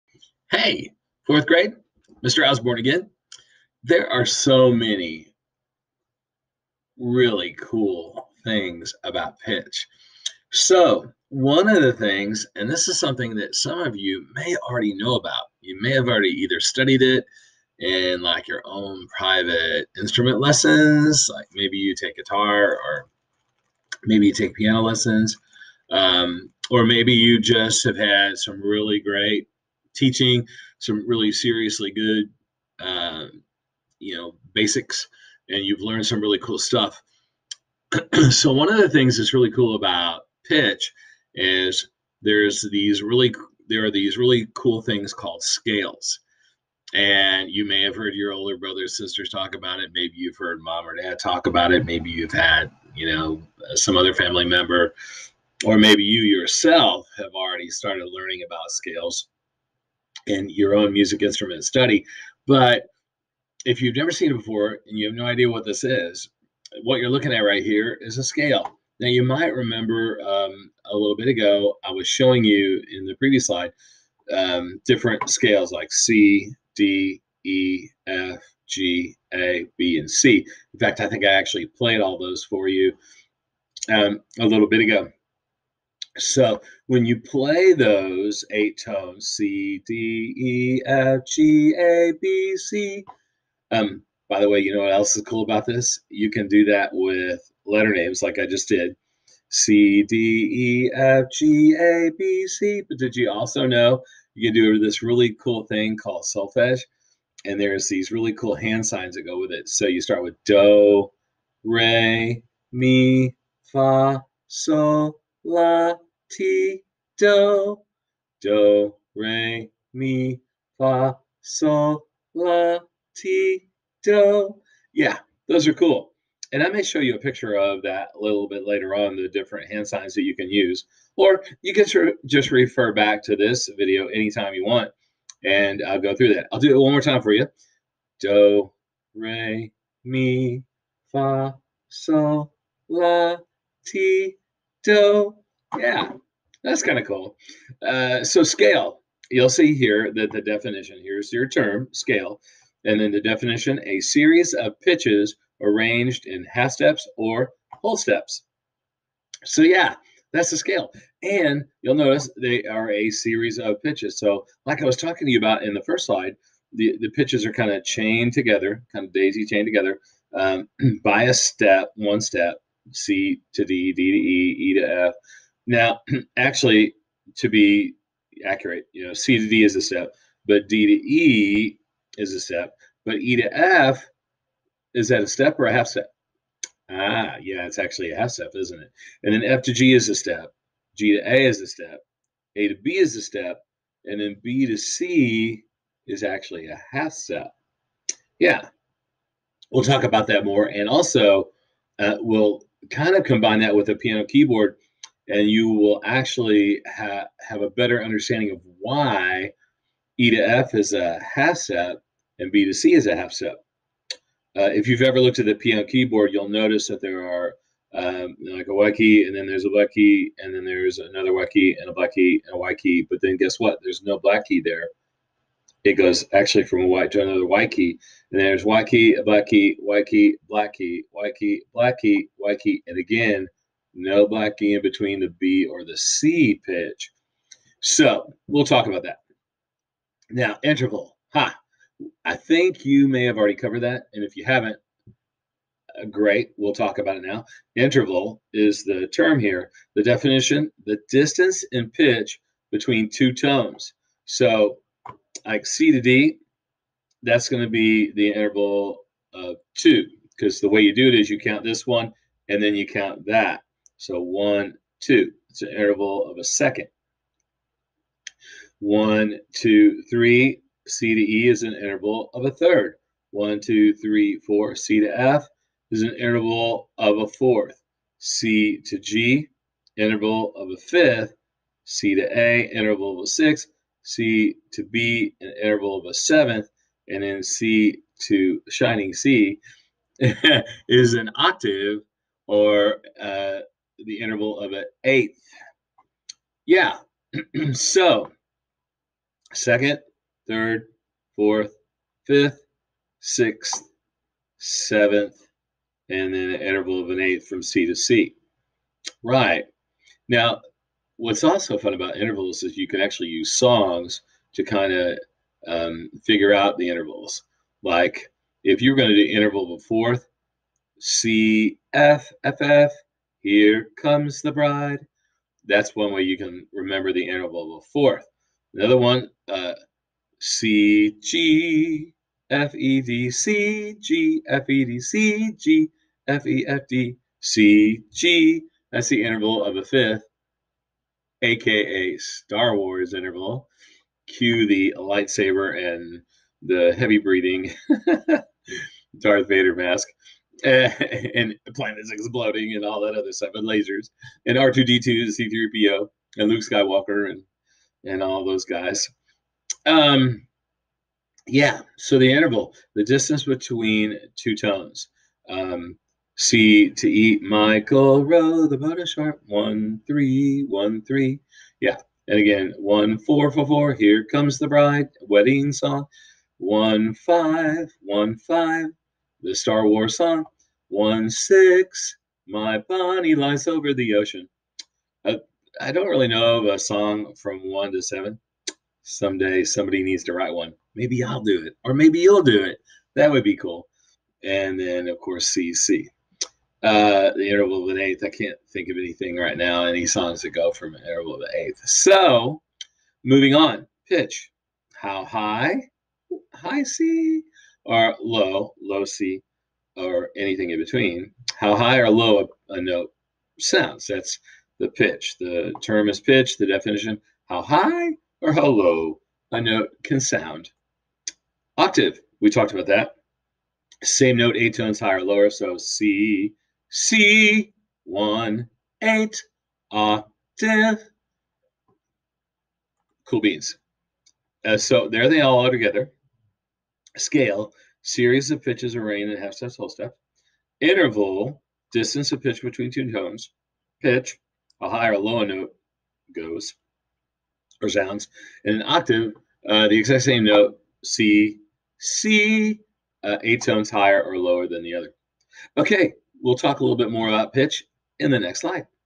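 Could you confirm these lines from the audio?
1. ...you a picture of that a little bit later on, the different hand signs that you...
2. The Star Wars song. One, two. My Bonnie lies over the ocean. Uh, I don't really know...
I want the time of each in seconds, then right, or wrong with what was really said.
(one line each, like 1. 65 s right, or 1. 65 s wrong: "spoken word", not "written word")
1. 126 s right
2. 379 s wrong: "six", not "two".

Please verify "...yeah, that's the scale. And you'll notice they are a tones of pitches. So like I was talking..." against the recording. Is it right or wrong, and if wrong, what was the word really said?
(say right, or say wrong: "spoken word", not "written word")
wrong: "series", not "tones".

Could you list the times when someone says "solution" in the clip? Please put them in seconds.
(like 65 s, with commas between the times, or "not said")
not said.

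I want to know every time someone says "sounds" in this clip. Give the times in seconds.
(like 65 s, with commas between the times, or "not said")
413 s, 420 s, 447 s.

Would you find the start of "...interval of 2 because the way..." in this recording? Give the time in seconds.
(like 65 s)
258 s.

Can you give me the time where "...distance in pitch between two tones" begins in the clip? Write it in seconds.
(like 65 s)
251 s.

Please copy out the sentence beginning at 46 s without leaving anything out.
And you may have heard your older brothers, sisters talk about it.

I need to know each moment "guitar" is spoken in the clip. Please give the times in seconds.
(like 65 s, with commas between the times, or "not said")
22 s.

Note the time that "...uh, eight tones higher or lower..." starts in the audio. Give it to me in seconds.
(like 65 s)
453 s.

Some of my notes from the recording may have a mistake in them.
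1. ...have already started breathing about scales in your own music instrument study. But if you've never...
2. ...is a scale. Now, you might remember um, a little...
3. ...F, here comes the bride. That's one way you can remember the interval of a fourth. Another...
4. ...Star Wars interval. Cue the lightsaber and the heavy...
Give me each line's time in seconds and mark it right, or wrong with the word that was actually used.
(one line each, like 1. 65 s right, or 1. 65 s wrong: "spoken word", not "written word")
1. 57 s wrong: "learning", not "breathing"
2. 68 s right
3. 322 s right
4. 342 s right.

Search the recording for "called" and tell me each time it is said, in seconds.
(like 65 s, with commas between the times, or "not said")
45 s, 105 s.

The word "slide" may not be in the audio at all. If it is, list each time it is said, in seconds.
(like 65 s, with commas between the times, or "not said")
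73 s, 166 s, 458 s.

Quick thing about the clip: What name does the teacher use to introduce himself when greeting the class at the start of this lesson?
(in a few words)
Mr. Osborn.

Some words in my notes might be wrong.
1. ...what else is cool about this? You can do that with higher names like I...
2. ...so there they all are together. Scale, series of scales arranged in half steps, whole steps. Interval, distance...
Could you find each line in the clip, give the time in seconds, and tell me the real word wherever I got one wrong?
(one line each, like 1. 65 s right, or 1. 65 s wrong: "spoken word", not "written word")
1. 94 s wrong: "letter", not "higher"
2. 434 s wrong: "pitches", not "scales".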